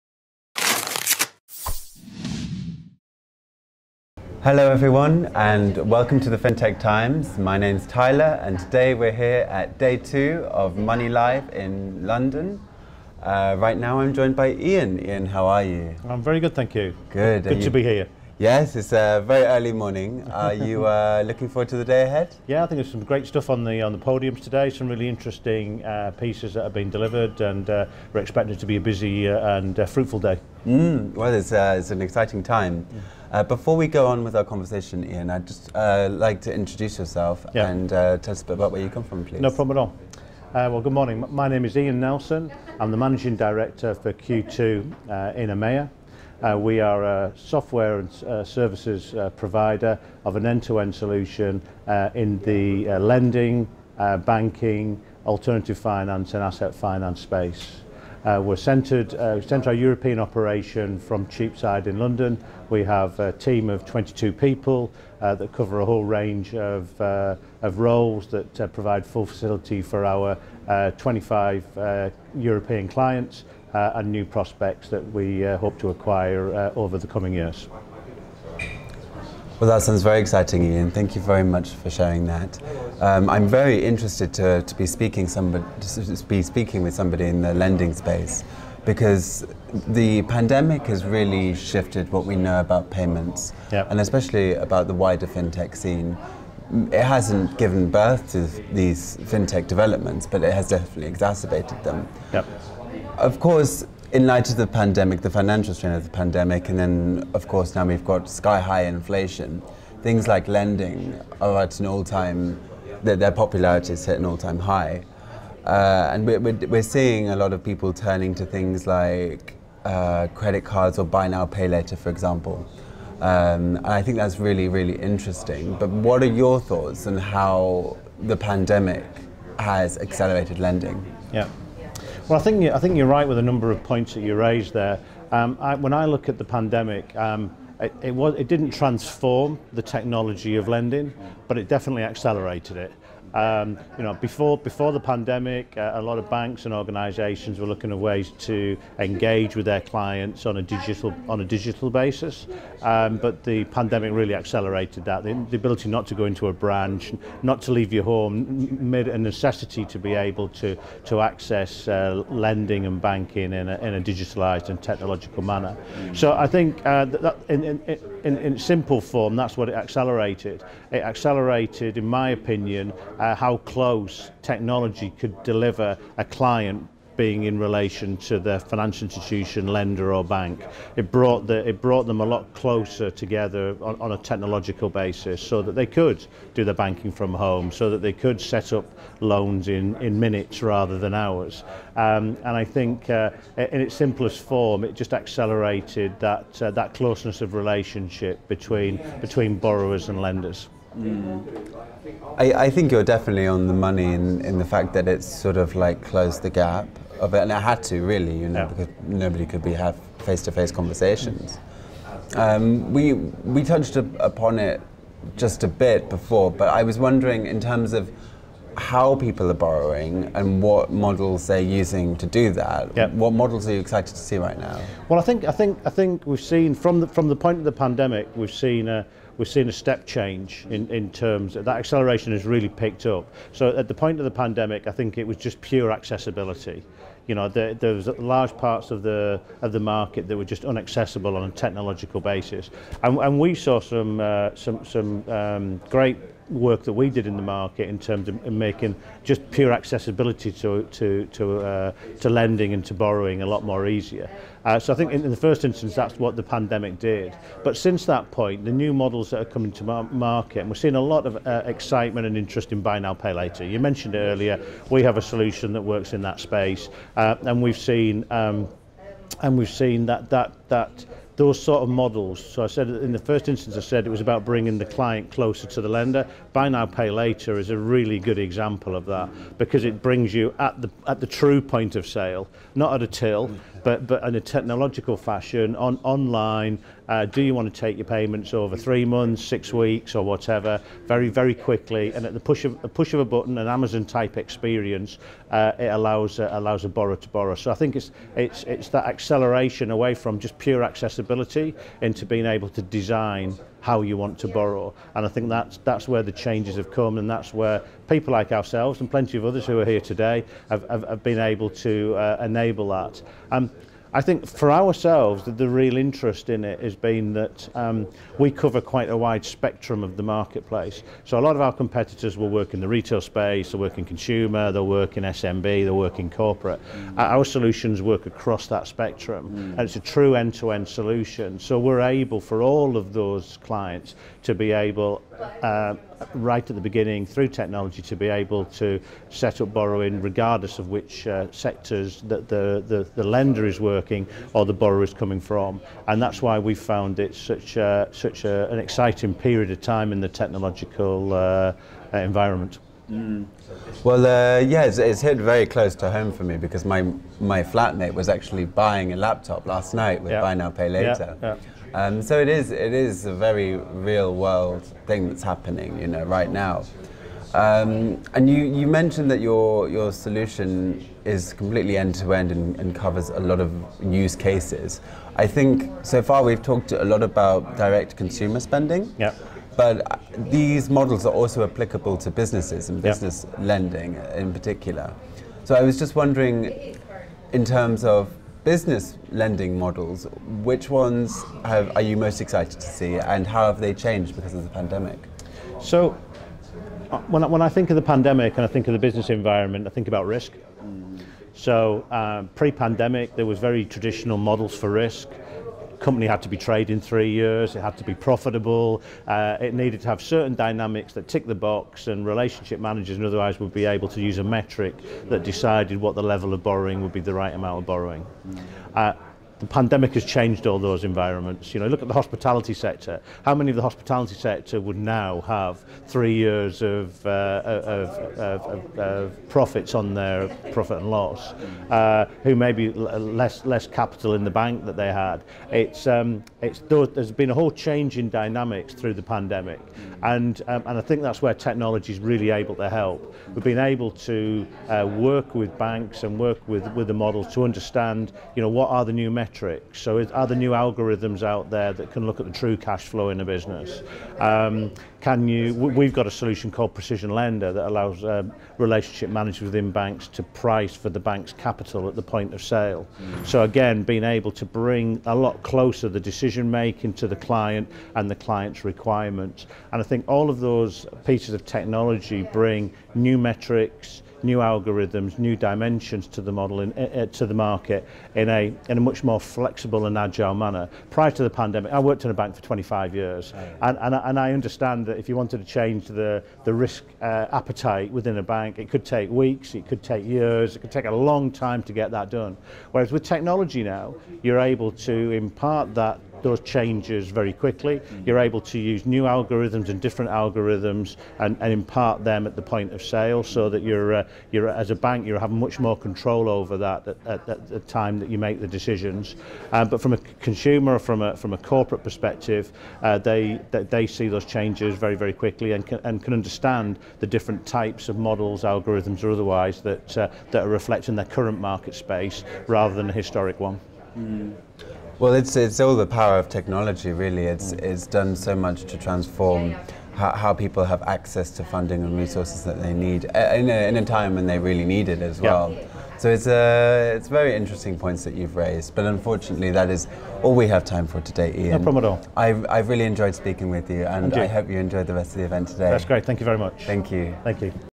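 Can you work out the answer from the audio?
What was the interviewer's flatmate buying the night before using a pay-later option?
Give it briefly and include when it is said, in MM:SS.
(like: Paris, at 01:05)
A laptop, at 05:59.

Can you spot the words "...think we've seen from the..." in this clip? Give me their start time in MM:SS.
03:45.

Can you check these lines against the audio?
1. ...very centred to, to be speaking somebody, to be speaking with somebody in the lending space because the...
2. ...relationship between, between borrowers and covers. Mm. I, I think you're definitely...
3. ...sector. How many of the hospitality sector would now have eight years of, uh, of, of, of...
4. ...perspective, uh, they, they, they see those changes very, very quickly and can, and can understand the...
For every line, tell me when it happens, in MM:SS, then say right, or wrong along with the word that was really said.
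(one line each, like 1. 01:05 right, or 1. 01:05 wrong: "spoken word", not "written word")
1. 01:23 wrong: "interested", not "centred"
2. 03:17 wrong: "lenders", not "covers"
3. 07:02 wrong: "three", not "eight"
4. 08:32 right.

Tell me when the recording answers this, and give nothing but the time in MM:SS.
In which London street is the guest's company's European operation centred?
01:01.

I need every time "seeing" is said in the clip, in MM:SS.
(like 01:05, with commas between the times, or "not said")
01:56, 04:20.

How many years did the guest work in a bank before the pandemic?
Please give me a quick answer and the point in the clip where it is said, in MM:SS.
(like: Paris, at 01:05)
25, at 08:02.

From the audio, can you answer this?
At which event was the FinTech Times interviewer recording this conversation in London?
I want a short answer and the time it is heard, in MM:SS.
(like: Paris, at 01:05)
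MoneyLIVE, at 00:10.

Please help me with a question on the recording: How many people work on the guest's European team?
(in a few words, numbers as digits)
22.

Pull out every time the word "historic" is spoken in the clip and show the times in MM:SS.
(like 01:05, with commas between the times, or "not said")
08:43.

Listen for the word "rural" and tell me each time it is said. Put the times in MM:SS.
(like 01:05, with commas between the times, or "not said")
not said.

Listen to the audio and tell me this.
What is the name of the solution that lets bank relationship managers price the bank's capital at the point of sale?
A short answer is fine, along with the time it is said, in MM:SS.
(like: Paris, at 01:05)
Precision Lender, at 07:36.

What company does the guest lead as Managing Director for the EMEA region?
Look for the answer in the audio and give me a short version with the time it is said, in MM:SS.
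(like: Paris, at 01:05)
Q2, at 00:44.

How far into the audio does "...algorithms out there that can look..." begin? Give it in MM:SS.
07:30.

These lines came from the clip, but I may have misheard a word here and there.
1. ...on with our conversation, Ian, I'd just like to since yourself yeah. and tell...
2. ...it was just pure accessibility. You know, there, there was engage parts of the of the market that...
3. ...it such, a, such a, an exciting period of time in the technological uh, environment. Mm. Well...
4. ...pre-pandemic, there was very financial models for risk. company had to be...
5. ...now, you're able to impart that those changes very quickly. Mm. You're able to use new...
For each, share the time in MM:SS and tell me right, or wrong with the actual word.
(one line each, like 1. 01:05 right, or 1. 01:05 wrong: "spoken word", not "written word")
1. 00:34 wrong: "introduce", not "since"
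2. 03:55 wrong: "large", not "engage"
3. 05:47 right
4. 06:42 wrong: "traditional", not "financial"
5. 08:13 right.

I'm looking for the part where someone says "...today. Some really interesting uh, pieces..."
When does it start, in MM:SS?
00:24.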